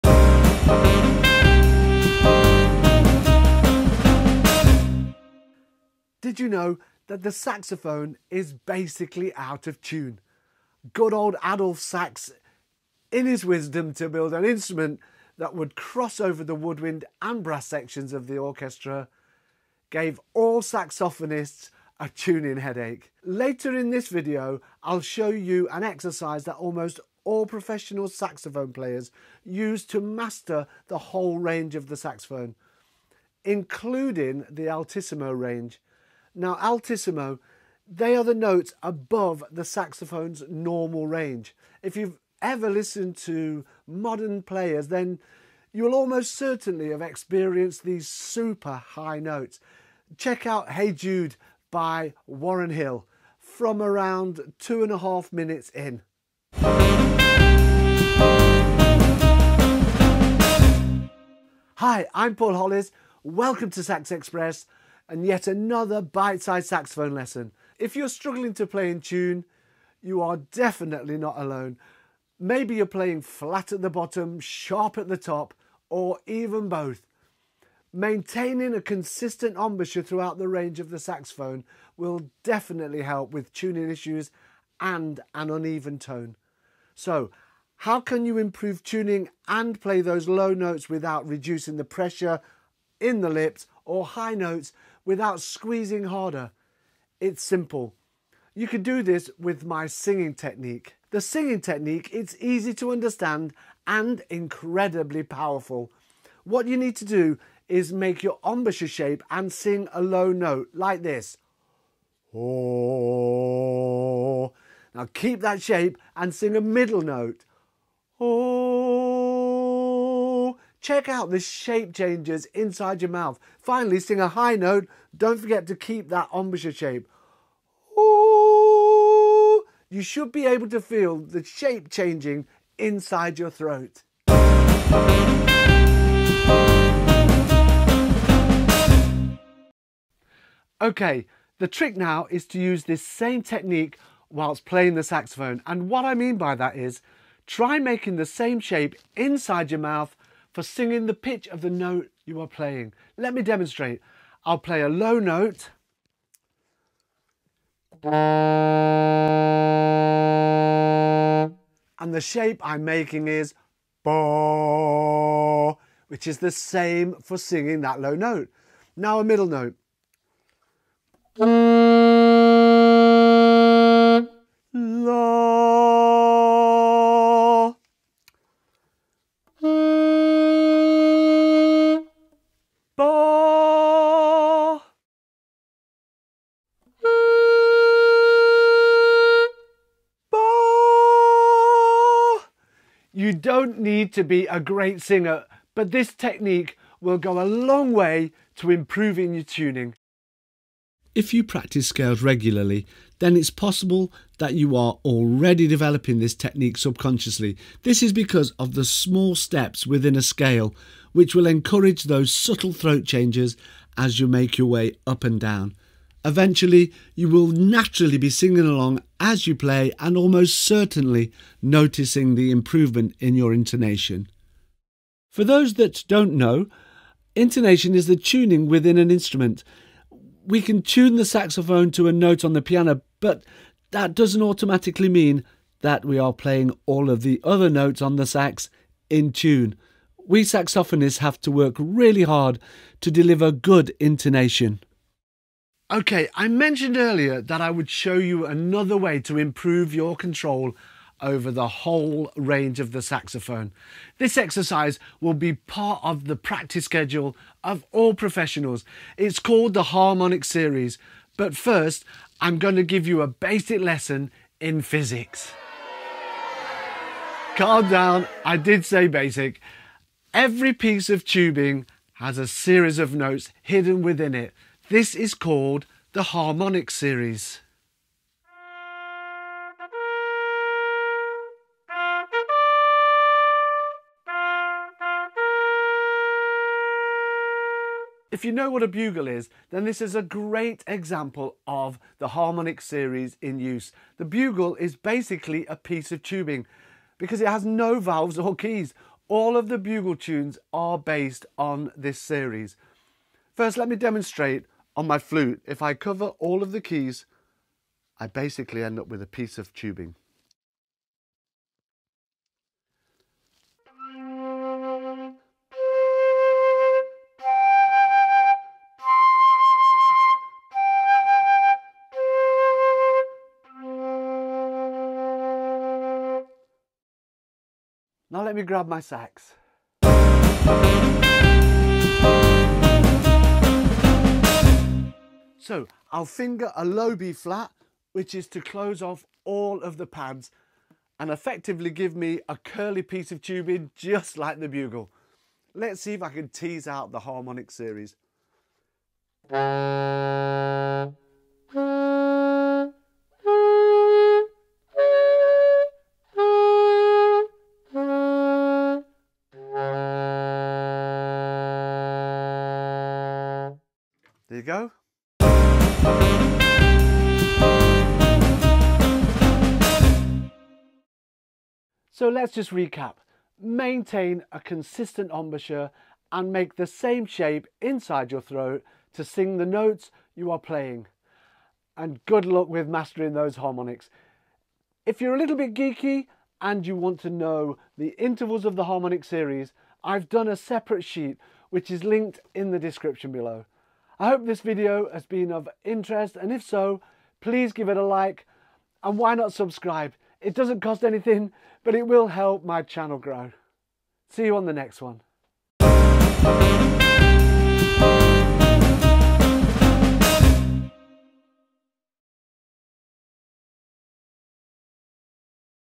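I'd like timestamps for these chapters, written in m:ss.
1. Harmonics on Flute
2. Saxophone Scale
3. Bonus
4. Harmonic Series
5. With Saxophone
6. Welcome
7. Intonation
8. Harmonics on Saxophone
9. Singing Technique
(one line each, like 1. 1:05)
1. 4:48
2. 3:20
3. 4:05
4. 4:38
5. 2:20
6. 1:07
7. 3:45
8. 5:35
9. 1:40.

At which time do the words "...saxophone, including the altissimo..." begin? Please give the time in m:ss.
0:31.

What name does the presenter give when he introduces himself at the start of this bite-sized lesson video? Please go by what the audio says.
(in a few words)
Paul Hollis.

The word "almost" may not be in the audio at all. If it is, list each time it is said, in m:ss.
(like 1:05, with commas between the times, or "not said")
0:26, 0:45, 3:40.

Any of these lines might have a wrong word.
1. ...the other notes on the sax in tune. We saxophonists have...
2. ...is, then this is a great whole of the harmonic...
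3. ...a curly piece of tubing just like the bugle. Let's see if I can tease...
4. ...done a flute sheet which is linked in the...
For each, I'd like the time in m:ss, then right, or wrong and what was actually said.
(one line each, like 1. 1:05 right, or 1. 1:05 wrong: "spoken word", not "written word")
1. 3:57 right
2. 4:49 wrong: "example", not "whole"
3. 5:42 right
4. 6:30 wrong: "separate", not "flute".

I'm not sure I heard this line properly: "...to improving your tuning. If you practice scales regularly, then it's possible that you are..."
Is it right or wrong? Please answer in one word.
right.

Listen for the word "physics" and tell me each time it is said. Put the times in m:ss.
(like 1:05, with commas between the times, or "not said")
4:24.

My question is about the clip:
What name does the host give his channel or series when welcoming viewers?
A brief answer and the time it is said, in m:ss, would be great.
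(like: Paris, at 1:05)
Sax Express, at 1:03.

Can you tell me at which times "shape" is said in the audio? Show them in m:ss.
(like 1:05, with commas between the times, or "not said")
1:48, 1:55, 2:01, 2:06, 2:11, 2:28, 2:42, 6:17.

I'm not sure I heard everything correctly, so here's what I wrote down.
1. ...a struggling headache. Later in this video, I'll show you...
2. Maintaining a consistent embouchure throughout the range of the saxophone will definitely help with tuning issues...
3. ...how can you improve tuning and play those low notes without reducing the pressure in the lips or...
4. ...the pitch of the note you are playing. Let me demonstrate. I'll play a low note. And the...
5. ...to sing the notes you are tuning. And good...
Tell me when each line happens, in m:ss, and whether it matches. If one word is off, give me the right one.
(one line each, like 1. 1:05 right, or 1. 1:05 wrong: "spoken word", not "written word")
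1. 0:21 wrong: "tuning", not "struggling"
2. 1:17 right
3. 1:27 right
4. 2:31 right
5. 6:19 wrong: "playing", not "tuning".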